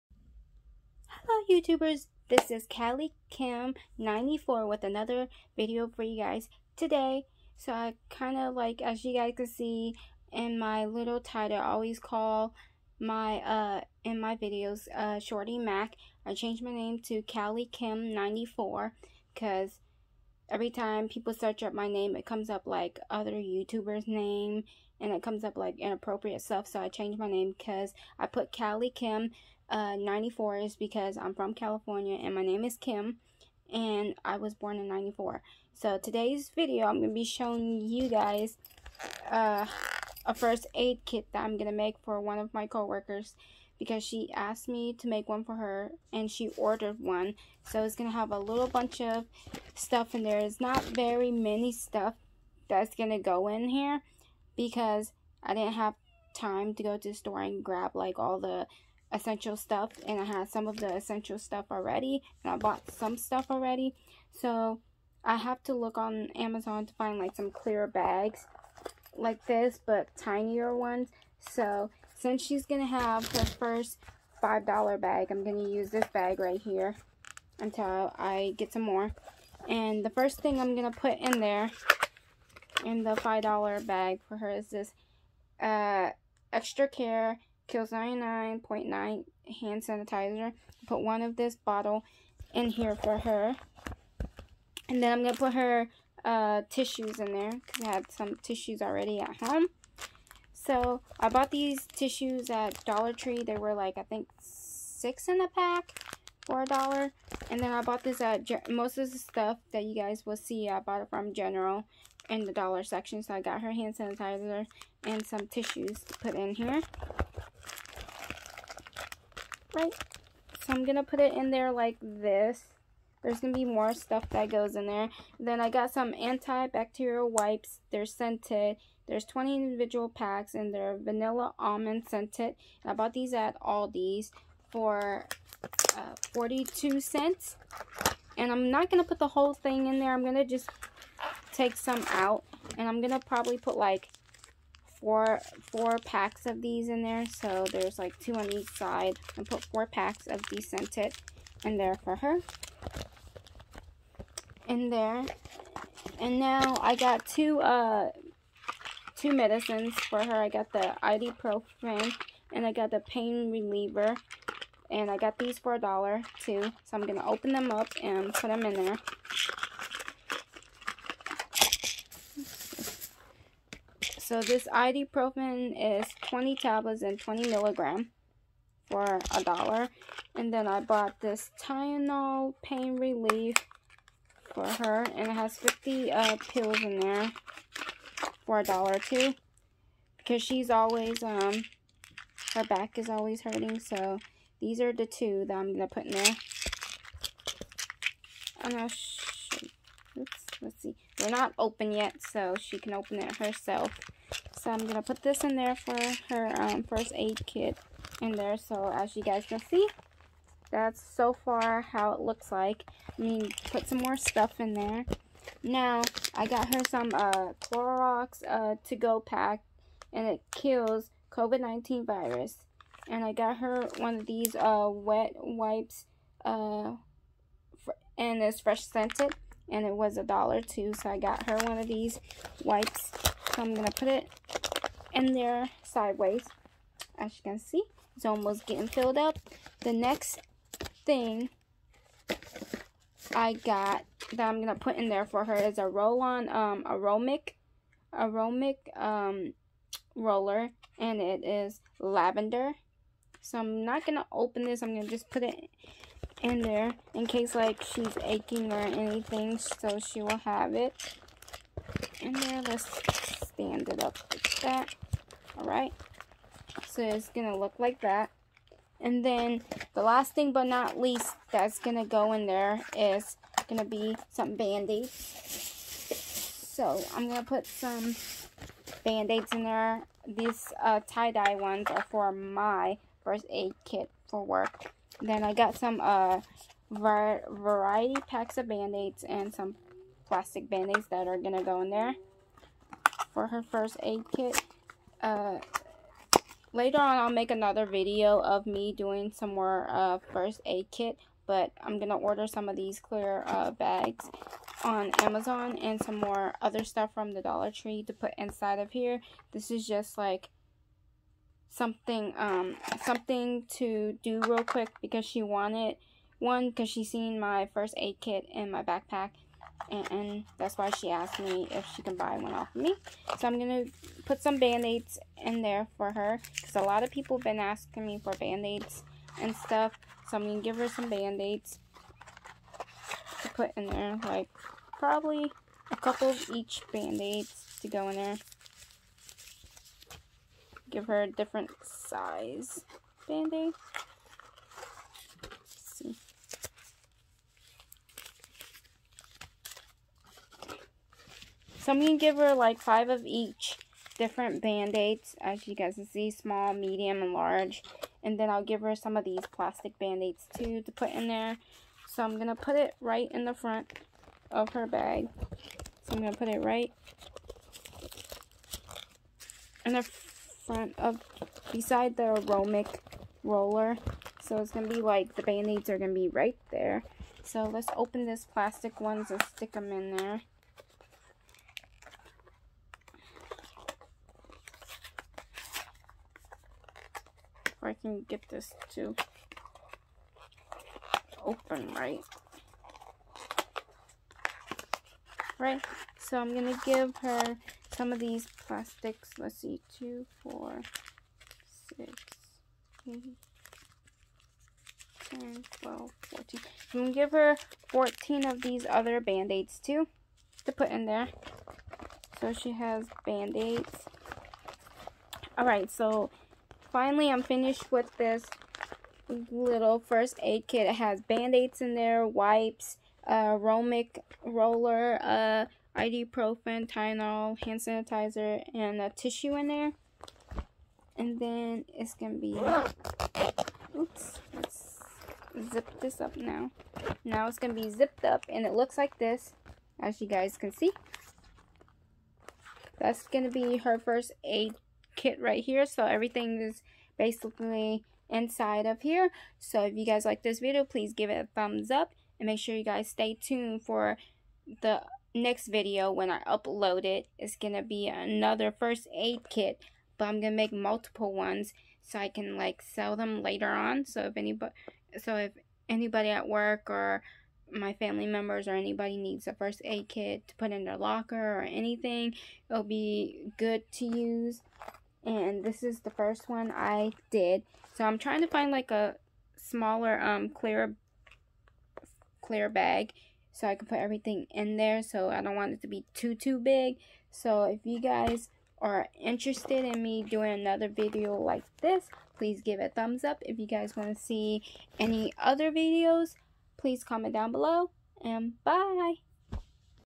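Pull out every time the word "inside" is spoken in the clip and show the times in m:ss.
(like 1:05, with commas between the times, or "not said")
5:08, 7:28.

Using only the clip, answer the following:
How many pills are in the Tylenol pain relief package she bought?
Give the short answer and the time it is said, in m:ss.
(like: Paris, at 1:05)
50, at 3:05.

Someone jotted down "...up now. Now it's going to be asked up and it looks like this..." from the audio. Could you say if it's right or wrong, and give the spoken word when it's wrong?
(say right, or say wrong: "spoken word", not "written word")
wrong: "zipped", not "asked".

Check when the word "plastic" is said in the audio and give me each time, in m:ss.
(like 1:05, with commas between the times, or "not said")
4:50, 5:59, 6:18, 6:38.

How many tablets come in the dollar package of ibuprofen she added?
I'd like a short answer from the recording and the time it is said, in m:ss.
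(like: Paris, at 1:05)
20, at 2:56.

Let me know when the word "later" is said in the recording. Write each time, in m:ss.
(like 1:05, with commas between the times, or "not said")
4:56, 7:43.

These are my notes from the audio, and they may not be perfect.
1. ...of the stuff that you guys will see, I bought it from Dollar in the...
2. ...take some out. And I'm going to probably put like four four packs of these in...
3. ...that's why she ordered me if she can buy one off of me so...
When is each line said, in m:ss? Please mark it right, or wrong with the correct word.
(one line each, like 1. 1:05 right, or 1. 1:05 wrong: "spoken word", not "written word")
1. 1:48 wrong: "General", not "Dollar"
2. 2:21 right
3. 5:20 wrong: "asked", not "ordered".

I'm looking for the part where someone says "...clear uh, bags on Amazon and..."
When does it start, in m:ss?
5:02.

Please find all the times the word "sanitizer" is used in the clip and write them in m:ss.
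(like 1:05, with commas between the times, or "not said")
1:29, 1:53, 7:07.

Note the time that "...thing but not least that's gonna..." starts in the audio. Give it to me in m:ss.
4:30.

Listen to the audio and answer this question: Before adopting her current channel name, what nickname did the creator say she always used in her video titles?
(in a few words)
Shorty Mac.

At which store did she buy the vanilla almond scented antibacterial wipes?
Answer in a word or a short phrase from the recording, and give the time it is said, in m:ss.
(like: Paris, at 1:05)
Aldi's, at 2:13.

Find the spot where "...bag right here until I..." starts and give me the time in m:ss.
1:16.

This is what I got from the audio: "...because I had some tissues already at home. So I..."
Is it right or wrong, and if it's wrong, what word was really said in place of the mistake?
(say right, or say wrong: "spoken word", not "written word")
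right.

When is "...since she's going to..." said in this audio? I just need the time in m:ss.
1:12.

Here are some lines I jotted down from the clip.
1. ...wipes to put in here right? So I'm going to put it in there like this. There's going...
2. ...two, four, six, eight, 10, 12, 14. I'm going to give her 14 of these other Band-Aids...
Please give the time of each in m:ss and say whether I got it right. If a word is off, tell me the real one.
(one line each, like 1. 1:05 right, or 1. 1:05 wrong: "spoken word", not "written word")
1. 1:55 wrong: "tissues", not "wipes"
2. 6:39 right.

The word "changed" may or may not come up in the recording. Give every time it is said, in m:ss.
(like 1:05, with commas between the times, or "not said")
0:16, 0:26.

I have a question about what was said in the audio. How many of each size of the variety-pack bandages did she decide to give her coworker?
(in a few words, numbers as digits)
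5.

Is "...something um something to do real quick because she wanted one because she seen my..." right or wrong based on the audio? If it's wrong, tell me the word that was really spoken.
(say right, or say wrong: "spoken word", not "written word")
right.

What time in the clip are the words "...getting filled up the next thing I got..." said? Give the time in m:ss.
3:58.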